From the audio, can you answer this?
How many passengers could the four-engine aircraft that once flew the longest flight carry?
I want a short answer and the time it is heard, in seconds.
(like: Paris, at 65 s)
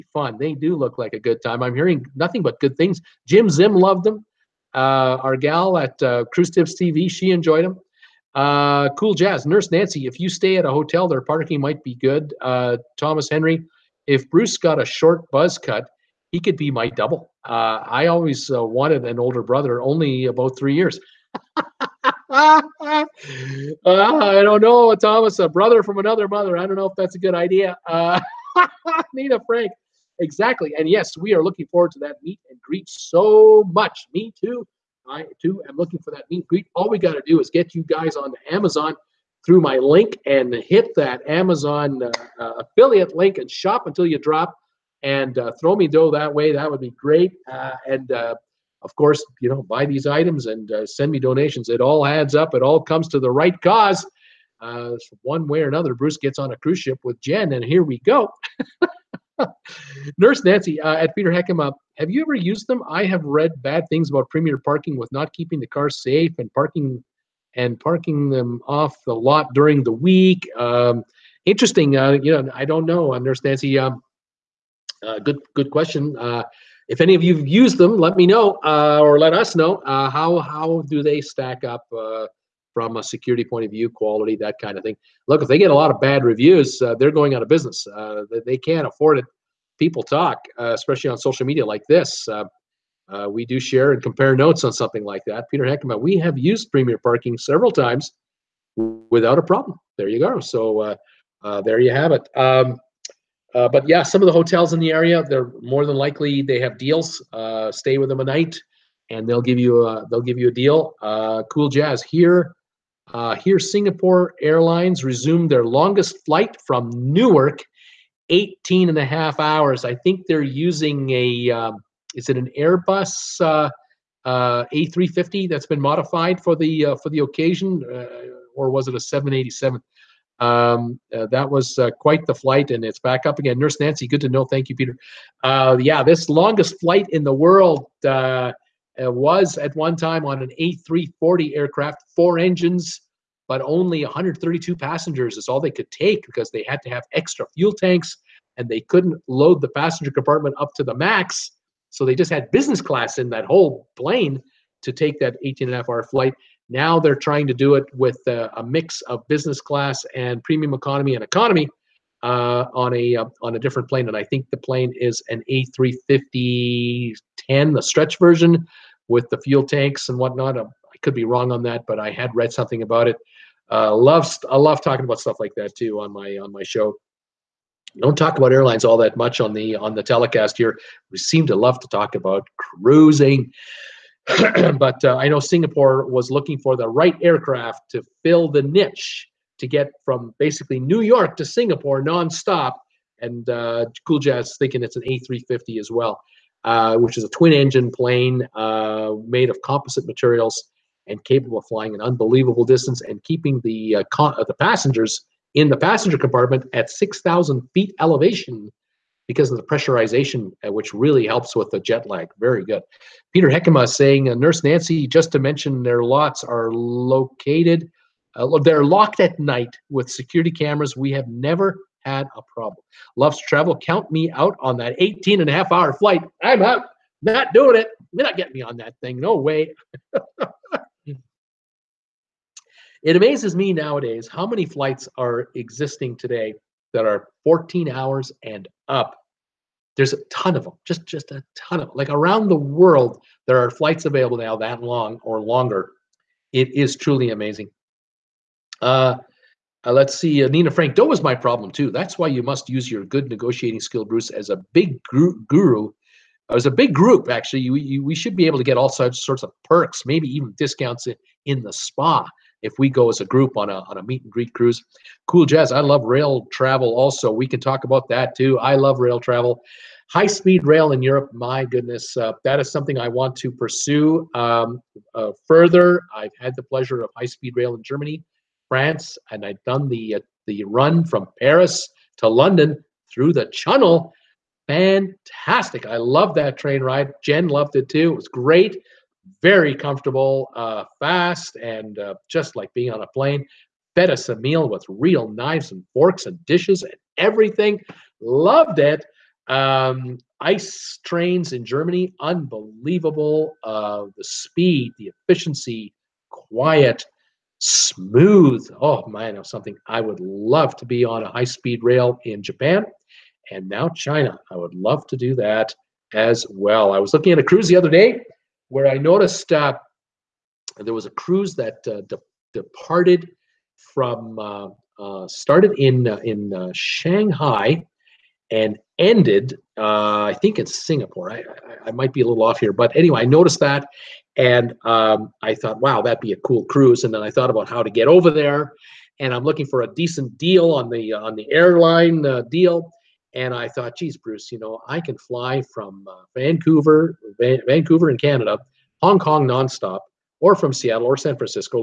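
132, at 144 s.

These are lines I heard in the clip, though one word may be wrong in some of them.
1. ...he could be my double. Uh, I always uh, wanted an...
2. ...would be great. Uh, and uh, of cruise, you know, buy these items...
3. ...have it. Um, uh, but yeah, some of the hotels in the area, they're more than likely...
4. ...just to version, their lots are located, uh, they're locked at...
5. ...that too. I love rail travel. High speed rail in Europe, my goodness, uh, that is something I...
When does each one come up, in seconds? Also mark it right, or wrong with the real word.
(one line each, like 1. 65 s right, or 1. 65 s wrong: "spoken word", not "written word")
1. 16 s right
2. 46 s wrong: "course", not "cruise"
3. 101 s right
4. 215 s wrong: "mention", not "version"
5. 268 s right.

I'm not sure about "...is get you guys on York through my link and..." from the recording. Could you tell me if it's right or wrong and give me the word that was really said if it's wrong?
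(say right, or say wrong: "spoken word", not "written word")
wrong: "Amazon", not "York".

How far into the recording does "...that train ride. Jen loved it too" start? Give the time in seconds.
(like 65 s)
286 s.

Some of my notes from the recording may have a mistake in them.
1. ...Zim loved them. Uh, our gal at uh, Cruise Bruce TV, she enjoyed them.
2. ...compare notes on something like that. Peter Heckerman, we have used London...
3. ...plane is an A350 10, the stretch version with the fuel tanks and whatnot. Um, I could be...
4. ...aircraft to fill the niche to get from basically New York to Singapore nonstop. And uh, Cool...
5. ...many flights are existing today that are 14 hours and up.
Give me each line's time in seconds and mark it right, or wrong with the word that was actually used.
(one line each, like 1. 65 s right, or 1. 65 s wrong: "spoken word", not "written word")
1. 3 s wrong: "Tips", not "Bruce"
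2. 94 s wrong: "Premier", not "London"
3. 164 s right
4. 187 s right
5. 234 s right.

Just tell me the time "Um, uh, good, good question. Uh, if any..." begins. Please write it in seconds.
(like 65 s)
73 s.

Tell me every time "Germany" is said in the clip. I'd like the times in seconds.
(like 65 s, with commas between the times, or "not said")
277 s, 301 s.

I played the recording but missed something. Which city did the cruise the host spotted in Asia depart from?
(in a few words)
Shanghai.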